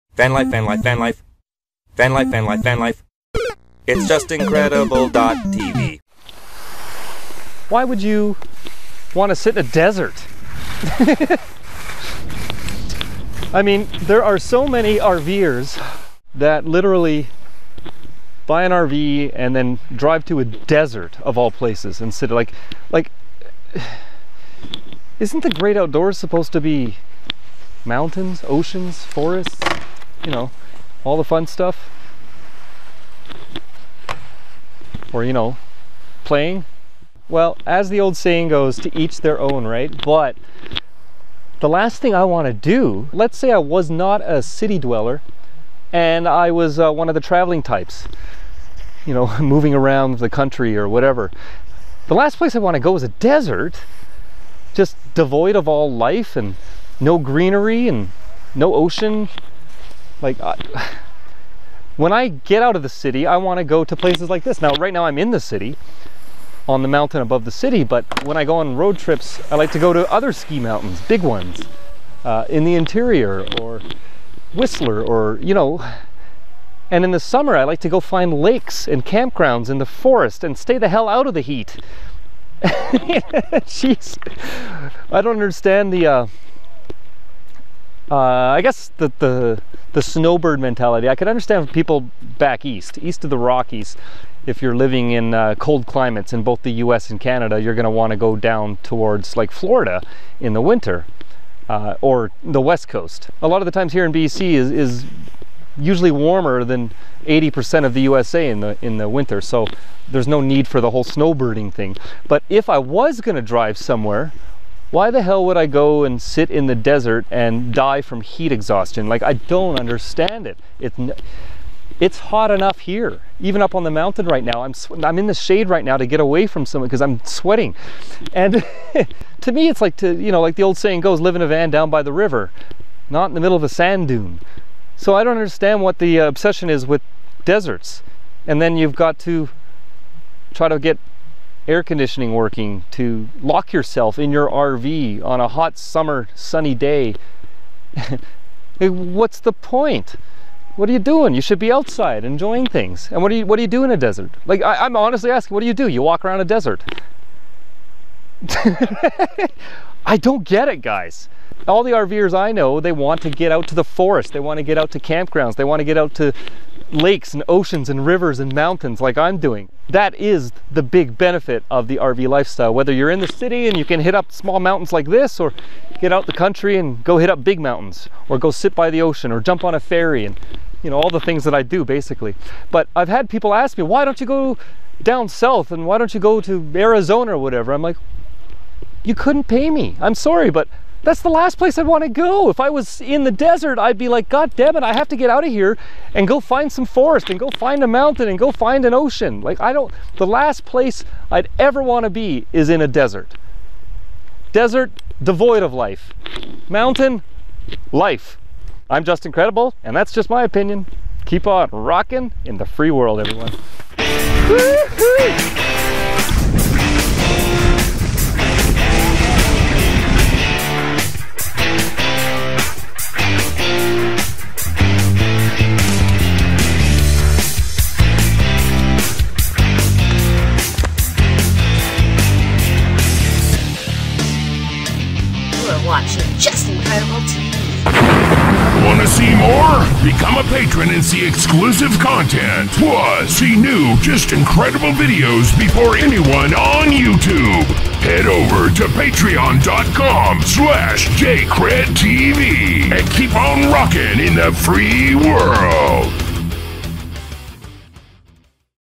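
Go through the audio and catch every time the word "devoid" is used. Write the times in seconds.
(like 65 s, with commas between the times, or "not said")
55 s, 205 s.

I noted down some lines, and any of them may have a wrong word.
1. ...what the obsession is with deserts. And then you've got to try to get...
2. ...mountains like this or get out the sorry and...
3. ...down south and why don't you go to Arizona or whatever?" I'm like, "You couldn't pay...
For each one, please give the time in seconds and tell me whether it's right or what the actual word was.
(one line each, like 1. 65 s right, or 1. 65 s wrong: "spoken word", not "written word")
1. 135 s right
2. 174 s wrong: "country", not "sorry"
3. 185 s right.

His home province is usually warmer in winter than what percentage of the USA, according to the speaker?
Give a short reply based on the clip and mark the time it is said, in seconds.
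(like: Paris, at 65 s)
80%, at 107 s.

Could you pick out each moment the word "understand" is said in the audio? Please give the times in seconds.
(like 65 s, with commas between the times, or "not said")
85 s, 91 s, 119 s, 135 s.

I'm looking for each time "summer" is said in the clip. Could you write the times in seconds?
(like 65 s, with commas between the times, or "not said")
77 s, 145 s.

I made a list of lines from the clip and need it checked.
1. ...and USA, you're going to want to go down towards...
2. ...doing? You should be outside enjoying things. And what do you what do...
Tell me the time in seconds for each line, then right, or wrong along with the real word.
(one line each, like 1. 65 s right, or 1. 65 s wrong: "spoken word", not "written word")
1. 97 s wrong: "Canada", not "USA"
2. 150 s right.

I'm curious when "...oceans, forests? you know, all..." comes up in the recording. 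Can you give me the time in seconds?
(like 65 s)
28 s.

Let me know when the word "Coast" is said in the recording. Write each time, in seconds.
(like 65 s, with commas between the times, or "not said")
102 s.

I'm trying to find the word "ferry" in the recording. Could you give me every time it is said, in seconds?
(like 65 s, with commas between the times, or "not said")
179 s.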